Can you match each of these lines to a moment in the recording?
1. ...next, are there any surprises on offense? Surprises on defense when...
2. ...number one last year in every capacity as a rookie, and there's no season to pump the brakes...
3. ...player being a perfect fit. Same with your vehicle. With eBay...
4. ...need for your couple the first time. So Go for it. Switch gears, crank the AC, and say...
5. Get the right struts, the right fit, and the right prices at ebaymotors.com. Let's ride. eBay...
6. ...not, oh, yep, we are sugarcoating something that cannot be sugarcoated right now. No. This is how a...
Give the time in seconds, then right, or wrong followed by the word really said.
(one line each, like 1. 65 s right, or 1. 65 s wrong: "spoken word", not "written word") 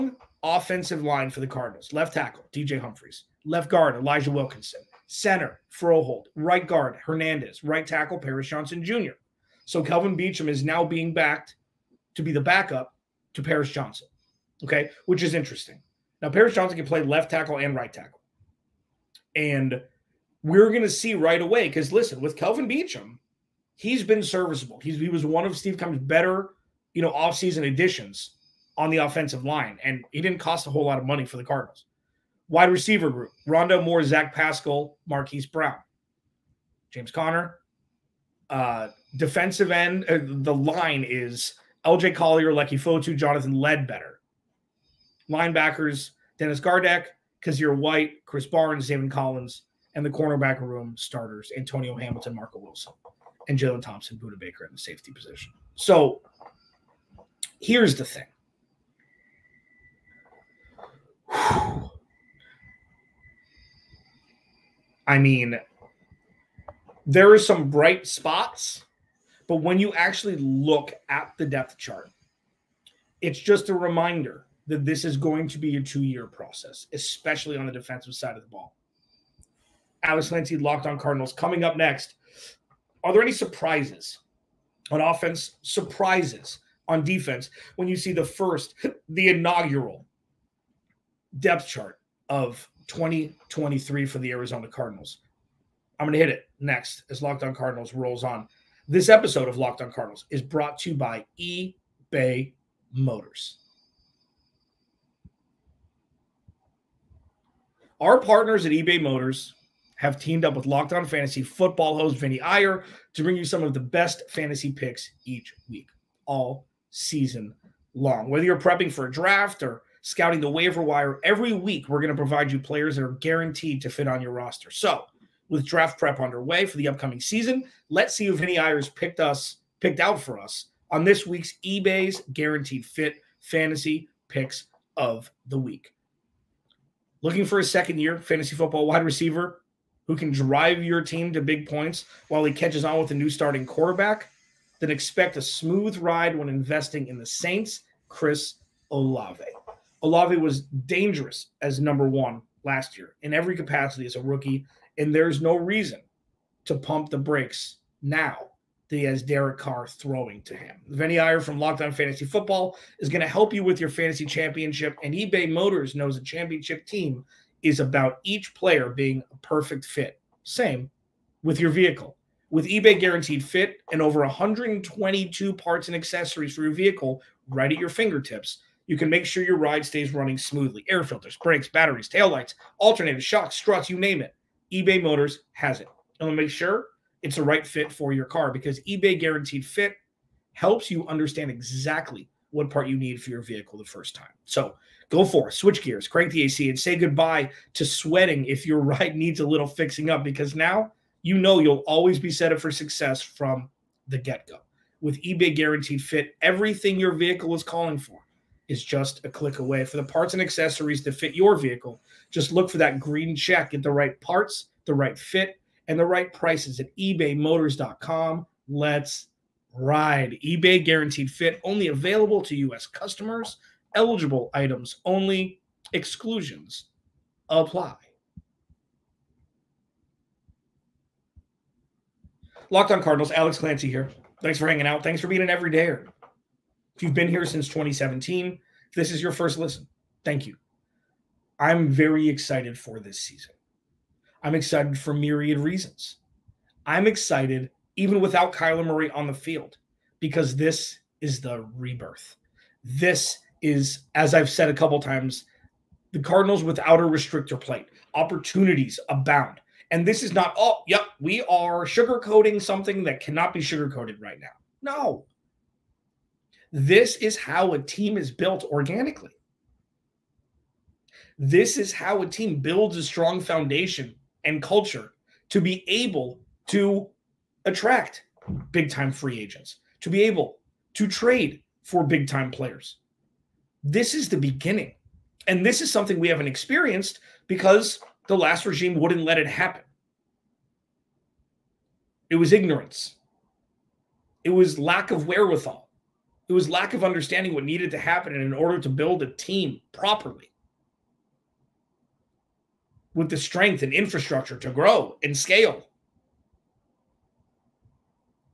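1. 81 s right
2. 151 s wrong: "reason", not "season"
3. 168 s right
4. 192 s wrong: "vehicle", not "couple"
5. 213 s wrong: "parts", not "struts"
6. 260 s right.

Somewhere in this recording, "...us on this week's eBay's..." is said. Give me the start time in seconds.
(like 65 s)
130 s.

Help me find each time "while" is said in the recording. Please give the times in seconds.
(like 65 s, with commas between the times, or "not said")
142 s.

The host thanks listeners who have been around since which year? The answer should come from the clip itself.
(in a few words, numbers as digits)
2017.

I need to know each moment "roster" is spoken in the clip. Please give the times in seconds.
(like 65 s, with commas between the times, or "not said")
124 s.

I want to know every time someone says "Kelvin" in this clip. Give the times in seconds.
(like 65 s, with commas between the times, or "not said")
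9 s, 22 s.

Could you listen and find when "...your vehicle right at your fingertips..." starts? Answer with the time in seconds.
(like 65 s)
176 s.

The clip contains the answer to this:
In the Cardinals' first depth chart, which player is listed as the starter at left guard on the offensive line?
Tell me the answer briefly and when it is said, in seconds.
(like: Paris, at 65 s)
Elijah Wilkinson, at 3 s.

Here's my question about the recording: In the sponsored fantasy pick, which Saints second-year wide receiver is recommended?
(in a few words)
Chris Olave.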